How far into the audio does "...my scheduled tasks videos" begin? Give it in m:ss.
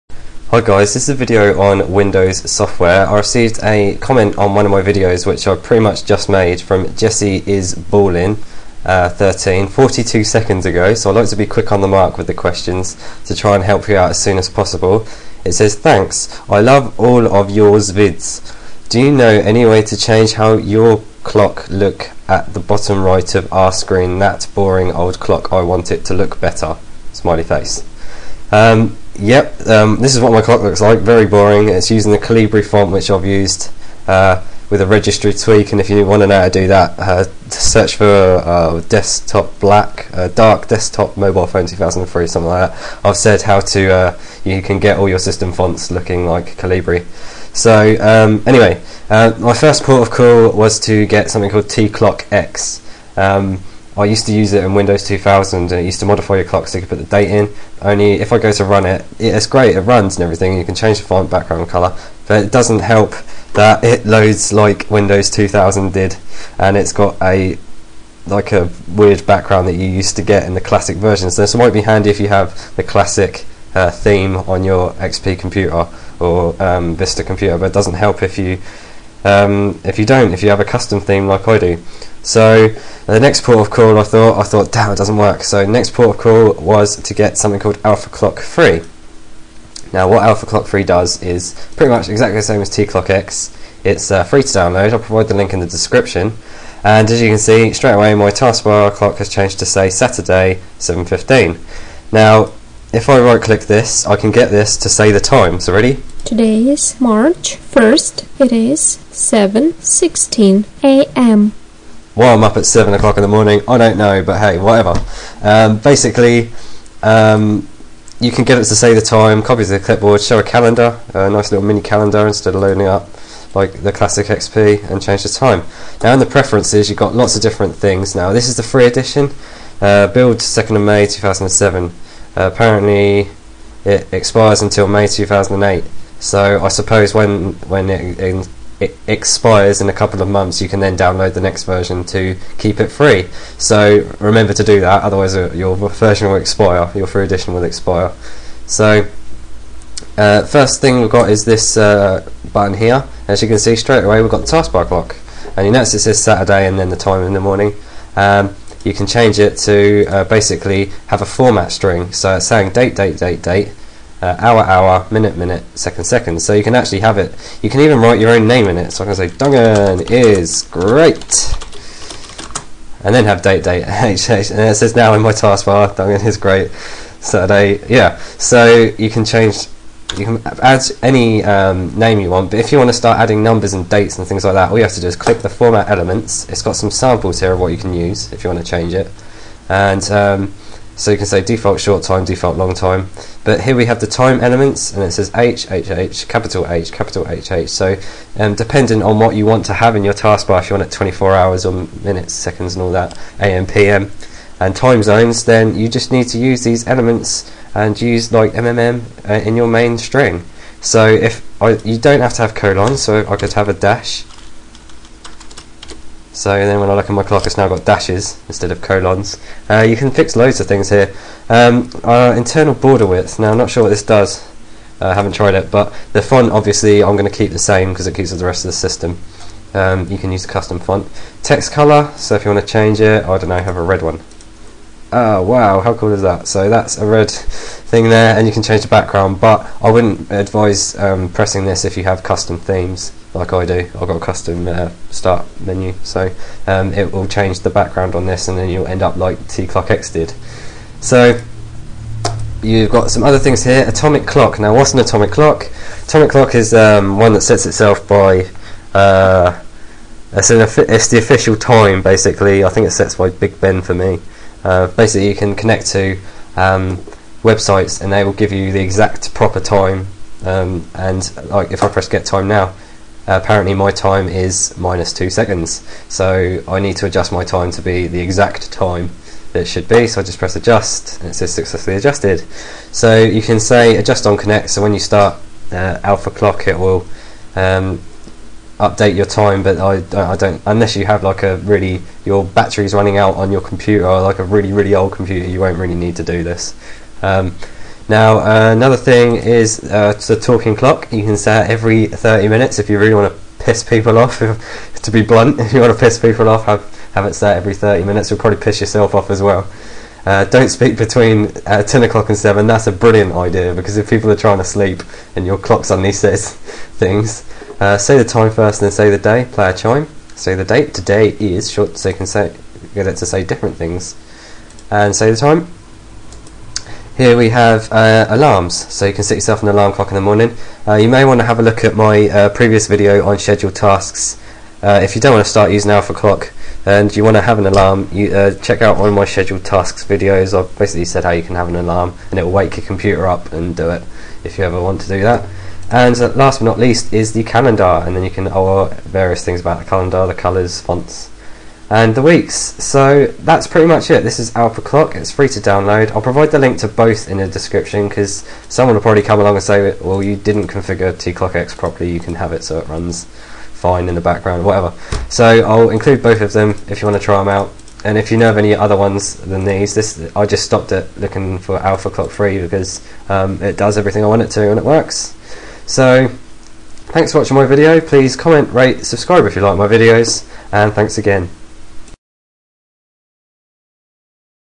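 5:39.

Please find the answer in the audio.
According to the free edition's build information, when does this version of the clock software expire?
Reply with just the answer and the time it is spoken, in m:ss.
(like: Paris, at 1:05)
May 2008, at 2:14.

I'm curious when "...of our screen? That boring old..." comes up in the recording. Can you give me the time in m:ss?
0:23.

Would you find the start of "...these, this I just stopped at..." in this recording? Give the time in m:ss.
6:09.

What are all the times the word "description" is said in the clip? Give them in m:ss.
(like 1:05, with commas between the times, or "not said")
1:35, 5:57.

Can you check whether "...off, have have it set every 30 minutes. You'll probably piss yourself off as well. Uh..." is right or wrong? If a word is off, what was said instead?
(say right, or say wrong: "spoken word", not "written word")
right.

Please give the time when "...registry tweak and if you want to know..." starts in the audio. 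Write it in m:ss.
0:34.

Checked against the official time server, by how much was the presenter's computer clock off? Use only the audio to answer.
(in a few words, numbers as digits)
minus 2 seconds.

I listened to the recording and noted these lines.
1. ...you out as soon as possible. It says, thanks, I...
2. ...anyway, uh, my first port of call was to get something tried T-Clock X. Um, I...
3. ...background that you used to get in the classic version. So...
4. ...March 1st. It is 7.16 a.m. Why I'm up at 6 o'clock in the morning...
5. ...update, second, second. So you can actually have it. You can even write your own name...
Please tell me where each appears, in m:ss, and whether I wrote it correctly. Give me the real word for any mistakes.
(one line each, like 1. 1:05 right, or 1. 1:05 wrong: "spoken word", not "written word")
1. 0:13 right
2. 0:48 wrong: "called", not "tried"
3. 1:09 right
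4. 1:47 wrong: "7", not "6"
5. 2:45 wrong: "minute", not "update".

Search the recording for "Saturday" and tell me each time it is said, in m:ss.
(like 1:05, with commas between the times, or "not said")
1:39, 2:36, 2:57.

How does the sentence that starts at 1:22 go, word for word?
So the next port of call I thought, I thought, damn, it doesn't work.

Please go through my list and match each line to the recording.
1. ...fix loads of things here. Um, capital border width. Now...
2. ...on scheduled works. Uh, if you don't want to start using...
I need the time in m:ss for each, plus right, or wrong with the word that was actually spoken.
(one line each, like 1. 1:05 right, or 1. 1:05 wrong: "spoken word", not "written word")
1. 3:40 wrong: "internal", not "capital"
2. 5:33 wrong: "tasks", not "works".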